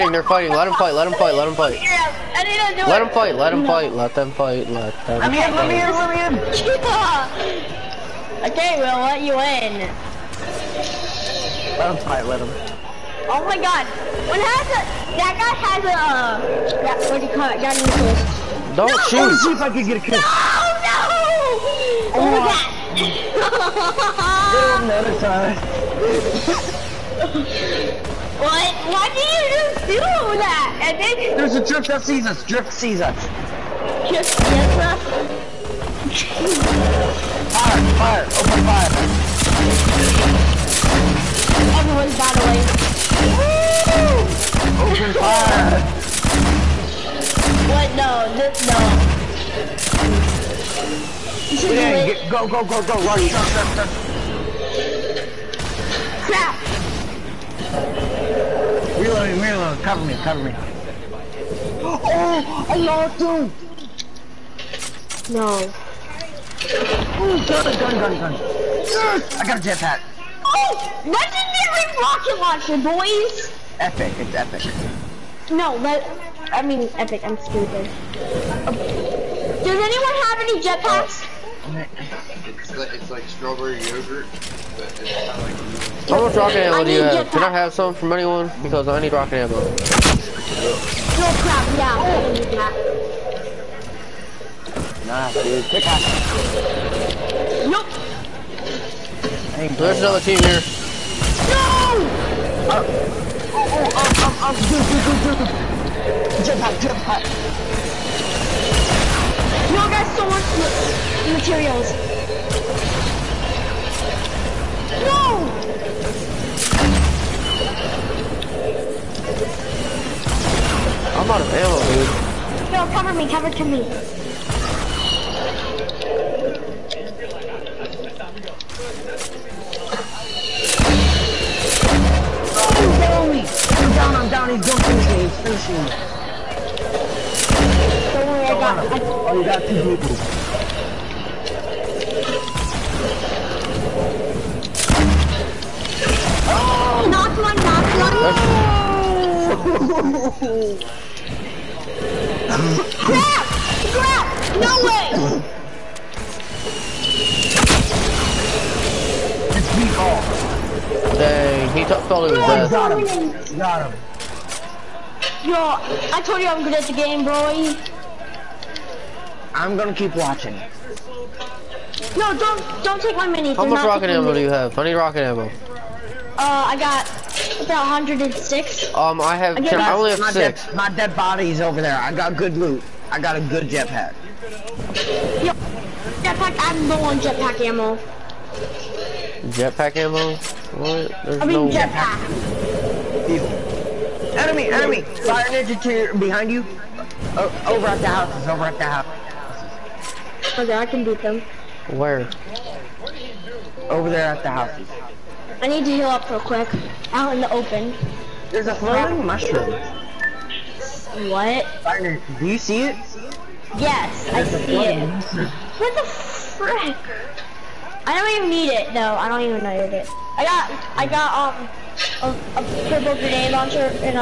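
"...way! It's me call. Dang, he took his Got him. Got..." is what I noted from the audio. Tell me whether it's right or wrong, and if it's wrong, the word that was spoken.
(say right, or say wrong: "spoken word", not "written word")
right.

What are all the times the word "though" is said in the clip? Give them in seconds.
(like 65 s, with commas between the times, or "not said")
218 s.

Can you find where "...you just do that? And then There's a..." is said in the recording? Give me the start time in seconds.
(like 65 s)
29 s.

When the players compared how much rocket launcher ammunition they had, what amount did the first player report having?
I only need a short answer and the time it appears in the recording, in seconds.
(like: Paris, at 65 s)
106, at 177 s.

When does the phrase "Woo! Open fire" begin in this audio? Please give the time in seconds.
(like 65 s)
44 s.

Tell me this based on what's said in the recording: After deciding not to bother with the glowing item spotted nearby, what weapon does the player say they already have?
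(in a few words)
purple grenade launcher.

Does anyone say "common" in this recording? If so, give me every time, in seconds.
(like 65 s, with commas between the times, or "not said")
not said.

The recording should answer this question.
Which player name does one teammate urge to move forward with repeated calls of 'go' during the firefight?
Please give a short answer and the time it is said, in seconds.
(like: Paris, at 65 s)
Ronnie, at 53 s.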